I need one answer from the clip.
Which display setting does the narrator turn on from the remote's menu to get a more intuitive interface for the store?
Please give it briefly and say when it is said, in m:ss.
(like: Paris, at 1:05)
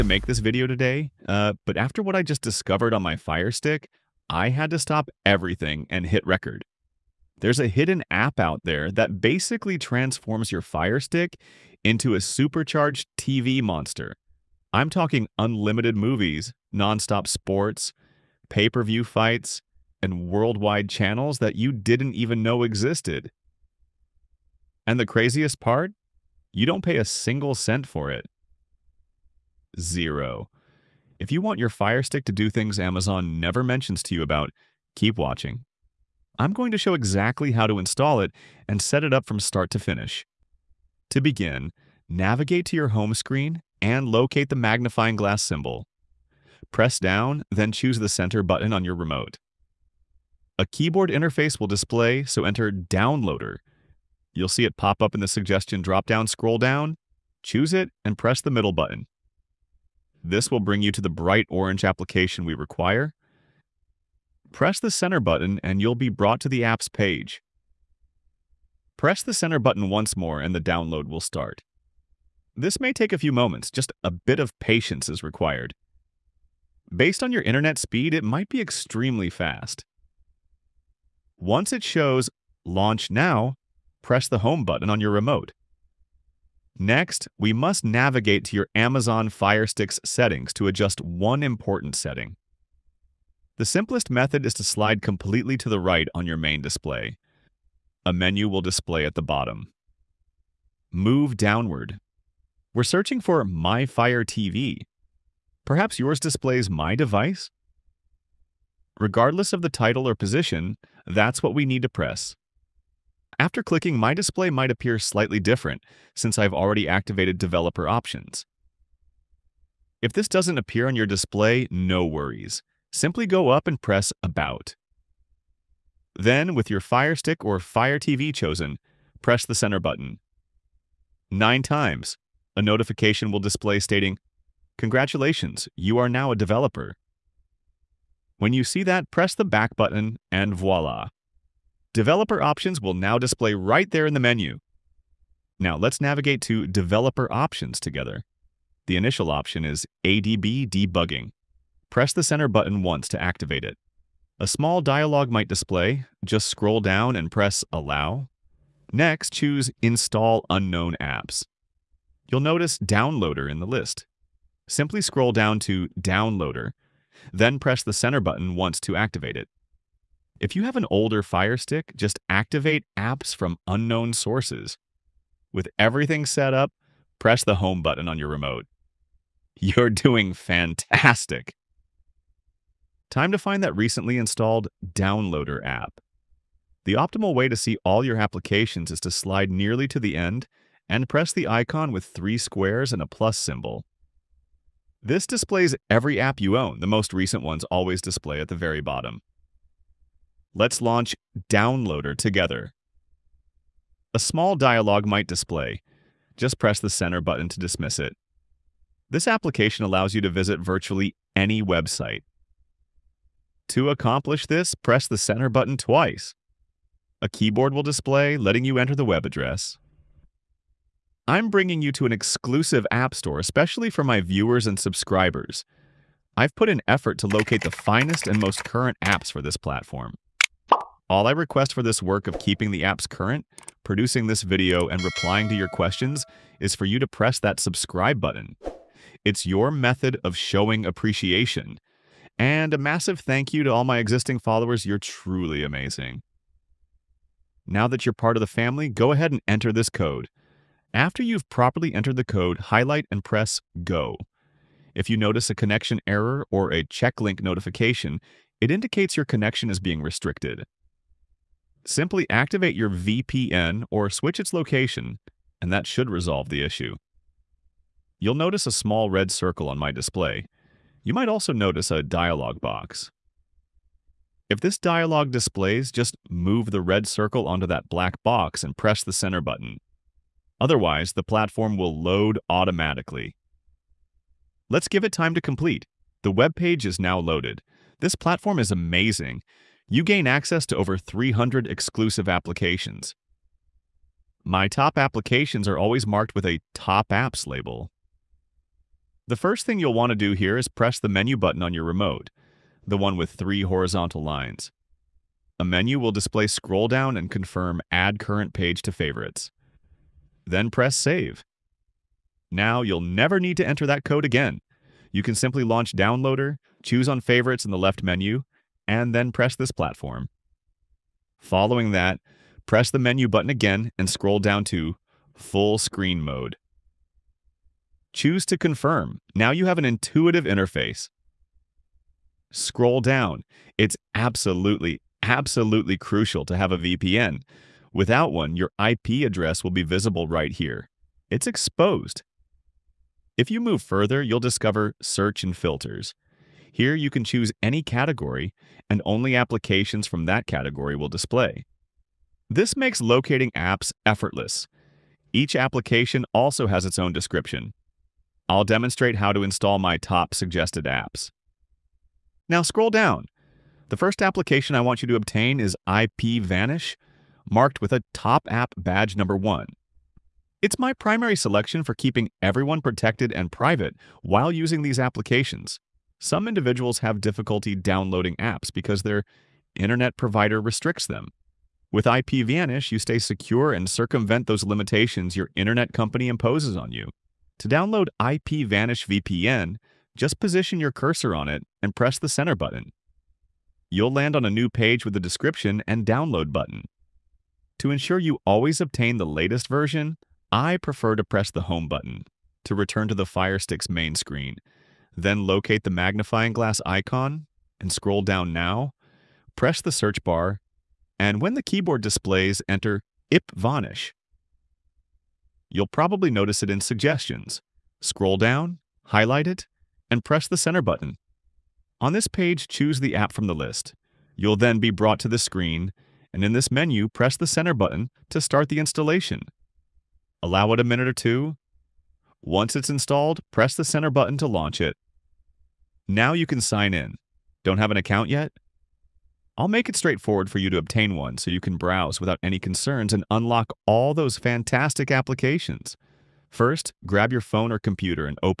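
Full Screen Mode, at 5:25.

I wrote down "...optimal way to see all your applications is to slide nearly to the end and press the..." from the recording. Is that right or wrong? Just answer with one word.
right.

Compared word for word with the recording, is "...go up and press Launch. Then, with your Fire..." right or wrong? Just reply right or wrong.
wrong.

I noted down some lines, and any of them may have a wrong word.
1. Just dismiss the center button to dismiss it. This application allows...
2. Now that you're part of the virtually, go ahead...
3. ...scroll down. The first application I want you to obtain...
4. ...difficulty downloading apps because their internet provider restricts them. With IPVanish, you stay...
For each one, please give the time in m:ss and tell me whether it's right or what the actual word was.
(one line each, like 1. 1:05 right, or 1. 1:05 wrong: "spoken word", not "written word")
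1. 3:26 wrong: "press", not "dismiss"
2. 4:07 wrong: "family", not "virtually"
3. 6:02 right
4. 6:17 right.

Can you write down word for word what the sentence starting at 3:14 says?
This displays every app you own.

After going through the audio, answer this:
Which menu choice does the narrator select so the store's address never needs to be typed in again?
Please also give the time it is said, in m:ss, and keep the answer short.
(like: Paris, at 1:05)
Add Current Page to Favorites, at 5:07.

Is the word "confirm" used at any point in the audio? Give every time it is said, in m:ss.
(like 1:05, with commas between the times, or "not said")
5:07, 5:28.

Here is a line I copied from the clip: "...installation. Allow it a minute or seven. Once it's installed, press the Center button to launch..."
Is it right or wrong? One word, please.
wrong.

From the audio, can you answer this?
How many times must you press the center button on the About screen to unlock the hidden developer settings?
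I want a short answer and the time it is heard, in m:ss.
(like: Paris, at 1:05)
9, at 2:11.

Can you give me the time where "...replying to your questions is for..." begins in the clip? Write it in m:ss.
3:55.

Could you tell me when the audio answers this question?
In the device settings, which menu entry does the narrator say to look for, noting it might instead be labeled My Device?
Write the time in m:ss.
1:43.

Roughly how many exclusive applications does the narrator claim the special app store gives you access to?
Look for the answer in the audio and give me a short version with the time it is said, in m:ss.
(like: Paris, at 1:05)
over 300, at 4:50.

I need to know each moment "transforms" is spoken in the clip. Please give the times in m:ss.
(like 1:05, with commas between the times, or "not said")
0:09.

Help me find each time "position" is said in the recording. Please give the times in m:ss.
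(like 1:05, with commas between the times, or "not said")
1:50, 6:30.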